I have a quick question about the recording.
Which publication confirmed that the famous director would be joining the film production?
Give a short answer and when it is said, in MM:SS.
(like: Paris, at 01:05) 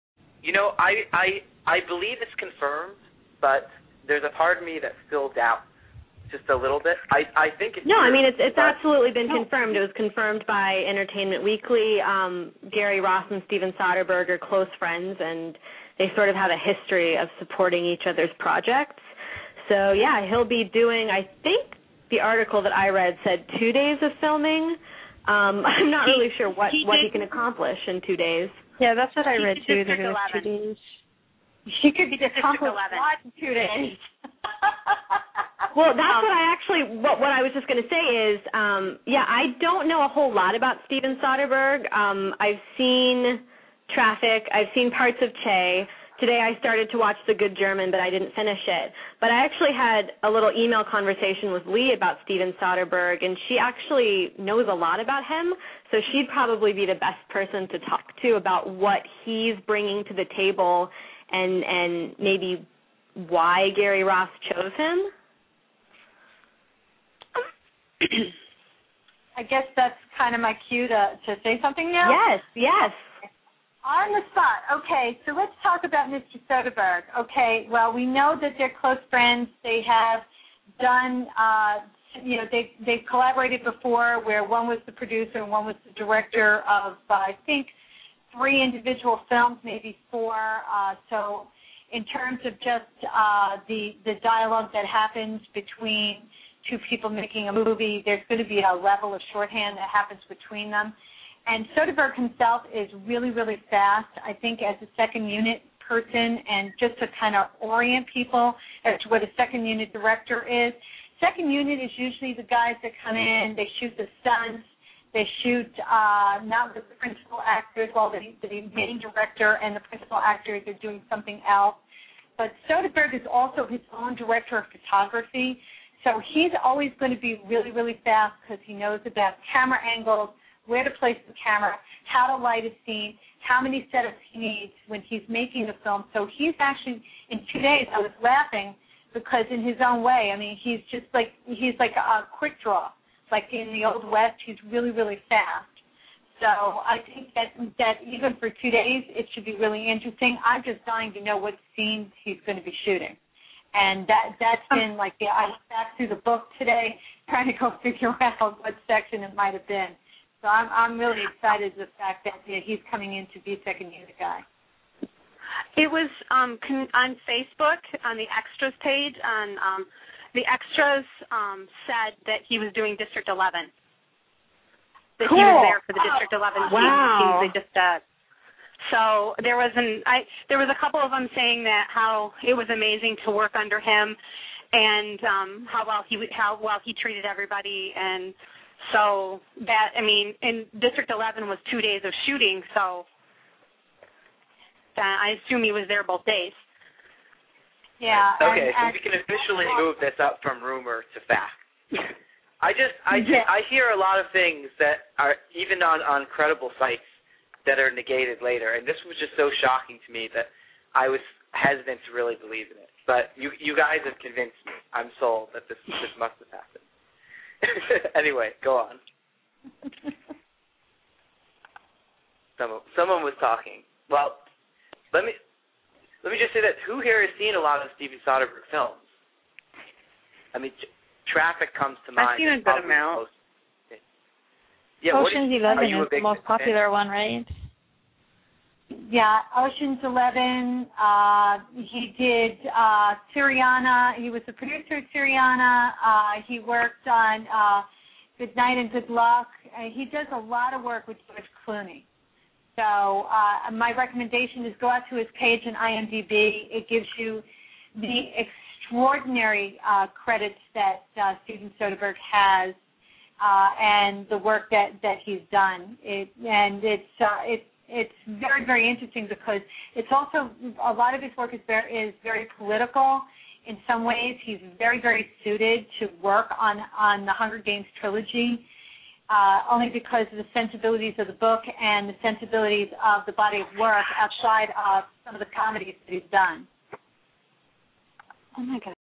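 Entertainment Weekly, at 00:10.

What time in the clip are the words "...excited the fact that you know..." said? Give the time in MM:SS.
02:41.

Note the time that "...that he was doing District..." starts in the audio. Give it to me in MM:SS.
02:52.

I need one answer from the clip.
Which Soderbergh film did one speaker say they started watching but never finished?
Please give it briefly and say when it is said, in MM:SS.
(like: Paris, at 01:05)
The Good German, at 00:47.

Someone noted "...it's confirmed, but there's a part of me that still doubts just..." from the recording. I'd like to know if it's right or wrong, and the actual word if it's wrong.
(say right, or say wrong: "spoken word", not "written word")
right.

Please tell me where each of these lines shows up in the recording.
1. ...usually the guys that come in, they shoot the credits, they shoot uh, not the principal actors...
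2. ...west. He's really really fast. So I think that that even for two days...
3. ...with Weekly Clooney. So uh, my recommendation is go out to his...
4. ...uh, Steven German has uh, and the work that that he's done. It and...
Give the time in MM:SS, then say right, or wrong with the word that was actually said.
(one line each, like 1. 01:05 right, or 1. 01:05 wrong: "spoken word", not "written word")
1. 01:51 wrong: "stunts", not "credits"
2. 02:24 right
3. 04:11 wrong: "George", not "Weekly"
4. 04:21 wrong: "Soderbergh", not "German".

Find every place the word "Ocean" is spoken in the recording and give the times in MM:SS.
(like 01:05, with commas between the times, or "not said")
03:55, 03:59.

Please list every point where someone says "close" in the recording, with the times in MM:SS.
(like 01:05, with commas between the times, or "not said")
00:14, 01:18.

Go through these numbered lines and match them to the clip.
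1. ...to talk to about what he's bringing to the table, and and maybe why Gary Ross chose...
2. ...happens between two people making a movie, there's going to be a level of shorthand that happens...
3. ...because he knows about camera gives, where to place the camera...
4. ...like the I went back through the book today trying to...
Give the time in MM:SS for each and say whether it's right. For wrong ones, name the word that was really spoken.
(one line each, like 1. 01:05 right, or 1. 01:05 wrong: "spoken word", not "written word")
1. 00:57 right
2. 01:34 right
3. 02:08 wrong: "angles", not "gives"
4. 02:34 right.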